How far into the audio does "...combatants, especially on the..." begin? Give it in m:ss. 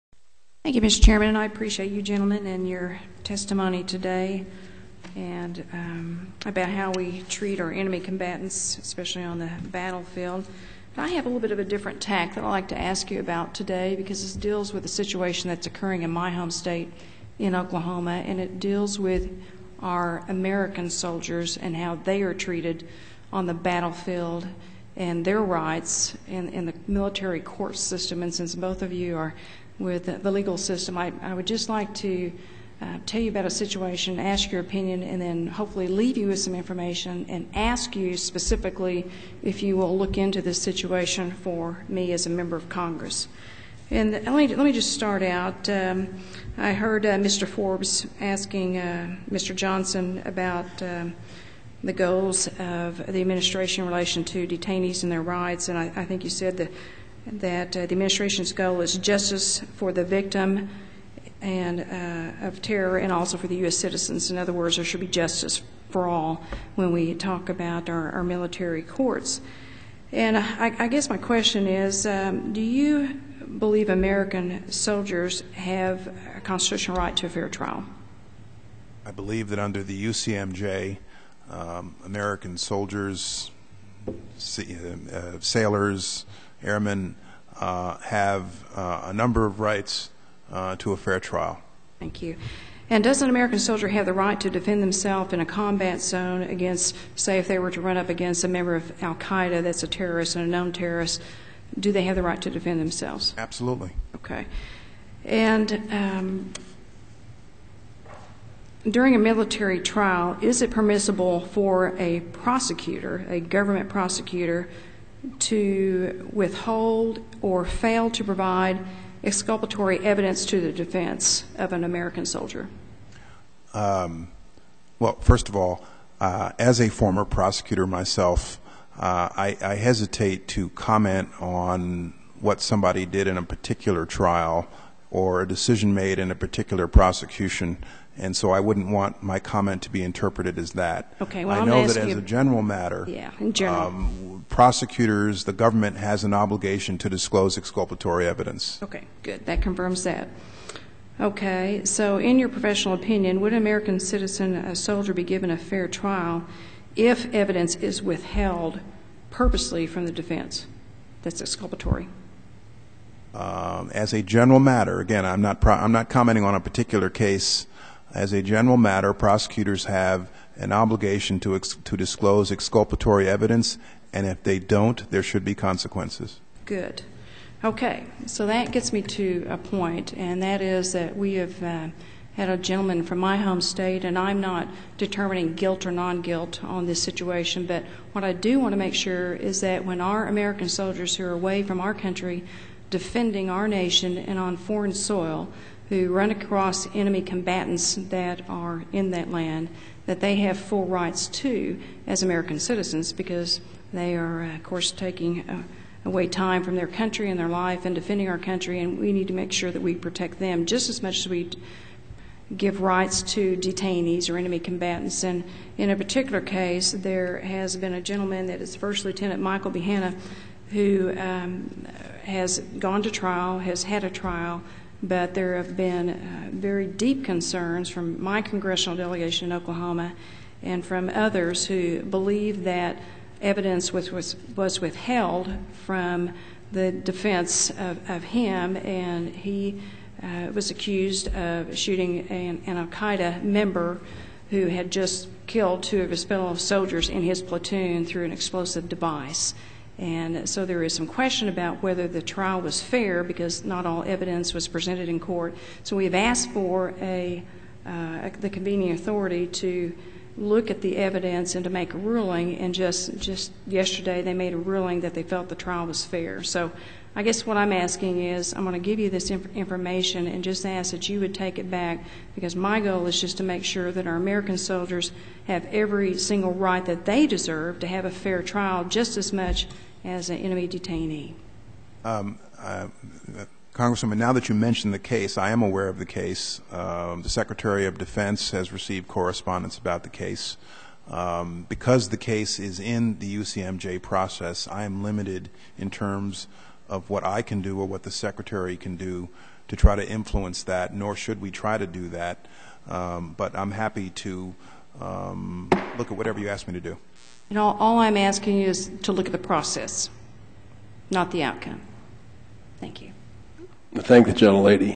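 0:07.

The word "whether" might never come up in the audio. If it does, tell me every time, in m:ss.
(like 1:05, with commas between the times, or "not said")
4:11.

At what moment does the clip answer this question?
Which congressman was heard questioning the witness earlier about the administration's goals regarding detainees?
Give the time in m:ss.
0:47.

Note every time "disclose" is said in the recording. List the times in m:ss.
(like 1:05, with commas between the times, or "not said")
2:27, 2:51.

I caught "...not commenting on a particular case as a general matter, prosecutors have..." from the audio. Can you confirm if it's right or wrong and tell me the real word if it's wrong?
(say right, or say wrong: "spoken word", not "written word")
right.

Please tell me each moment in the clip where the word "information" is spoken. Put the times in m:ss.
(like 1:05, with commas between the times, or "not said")
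0:36, 4:29.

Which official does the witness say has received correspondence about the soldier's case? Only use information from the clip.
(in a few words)
Secretary of Defense.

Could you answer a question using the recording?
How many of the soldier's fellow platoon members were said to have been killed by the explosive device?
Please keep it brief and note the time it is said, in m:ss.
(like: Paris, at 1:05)
2, at 4:05.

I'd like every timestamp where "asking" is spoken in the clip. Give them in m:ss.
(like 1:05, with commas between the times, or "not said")
0:48, 4:27, 5:08.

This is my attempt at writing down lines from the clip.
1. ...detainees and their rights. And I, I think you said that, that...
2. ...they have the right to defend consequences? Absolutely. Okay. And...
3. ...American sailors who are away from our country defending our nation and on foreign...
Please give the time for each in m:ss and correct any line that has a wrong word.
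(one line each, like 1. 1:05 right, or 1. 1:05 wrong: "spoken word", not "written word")
1. 0:54 right
2. 1:41 wrong: "themselves", not "consequences"
3. 3:10 wrong: "soldiers", not "sailors".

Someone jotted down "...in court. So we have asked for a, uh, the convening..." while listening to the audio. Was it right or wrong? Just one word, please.
right.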